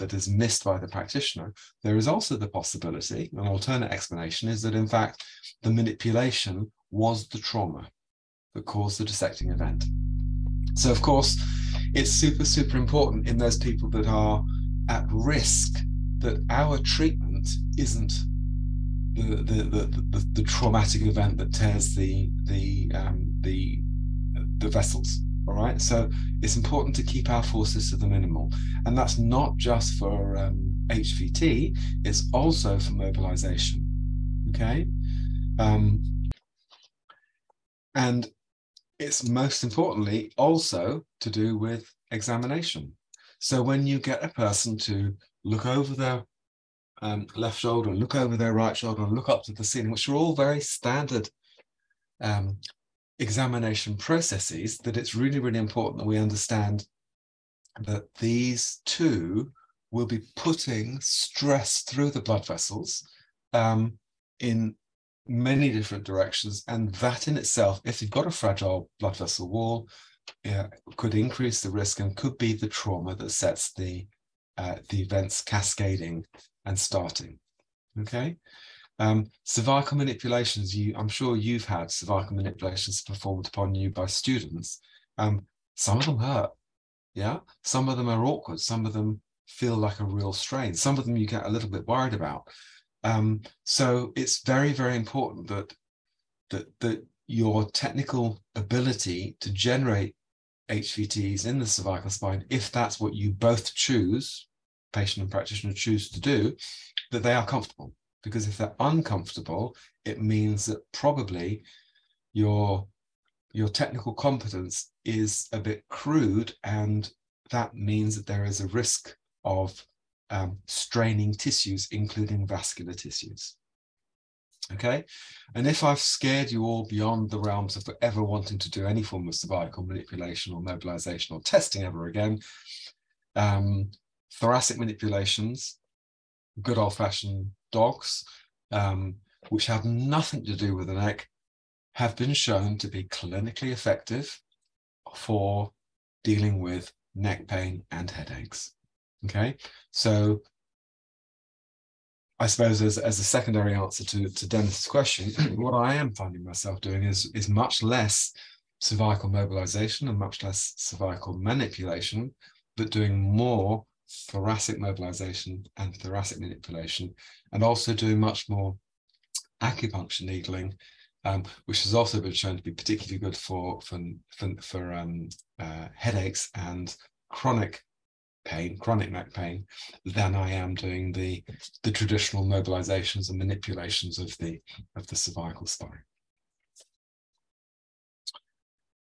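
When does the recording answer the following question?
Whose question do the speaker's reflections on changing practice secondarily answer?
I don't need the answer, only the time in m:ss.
2:34.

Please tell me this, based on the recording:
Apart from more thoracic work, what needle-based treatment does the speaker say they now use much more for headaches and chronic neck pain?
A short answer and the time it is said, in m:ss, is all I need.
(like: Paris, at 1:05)
acupuncture needling, at 2:49.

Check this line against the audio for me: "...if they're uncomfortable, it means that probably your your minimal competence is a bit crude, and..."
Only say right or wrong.
wrong.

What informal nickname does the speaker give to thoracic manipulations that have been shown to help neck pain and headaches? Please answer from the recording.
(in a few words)
dogs.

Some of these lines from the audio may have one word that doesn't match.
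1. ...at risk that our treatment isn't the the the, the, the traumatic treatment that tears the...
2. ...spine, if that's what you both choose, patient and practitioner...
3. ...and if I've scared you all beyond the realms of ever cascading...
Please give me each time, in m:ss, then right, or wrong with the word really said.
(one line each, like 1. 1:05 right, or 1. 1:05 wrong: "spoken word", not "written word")
1. 0:14 wrong: "event", not "treatment"
2. 1:42 right
3. 2:05 wrong: "wanting", not "cascading".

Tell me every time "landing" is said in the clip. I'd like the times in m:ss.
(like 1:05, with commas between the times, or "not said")
not said.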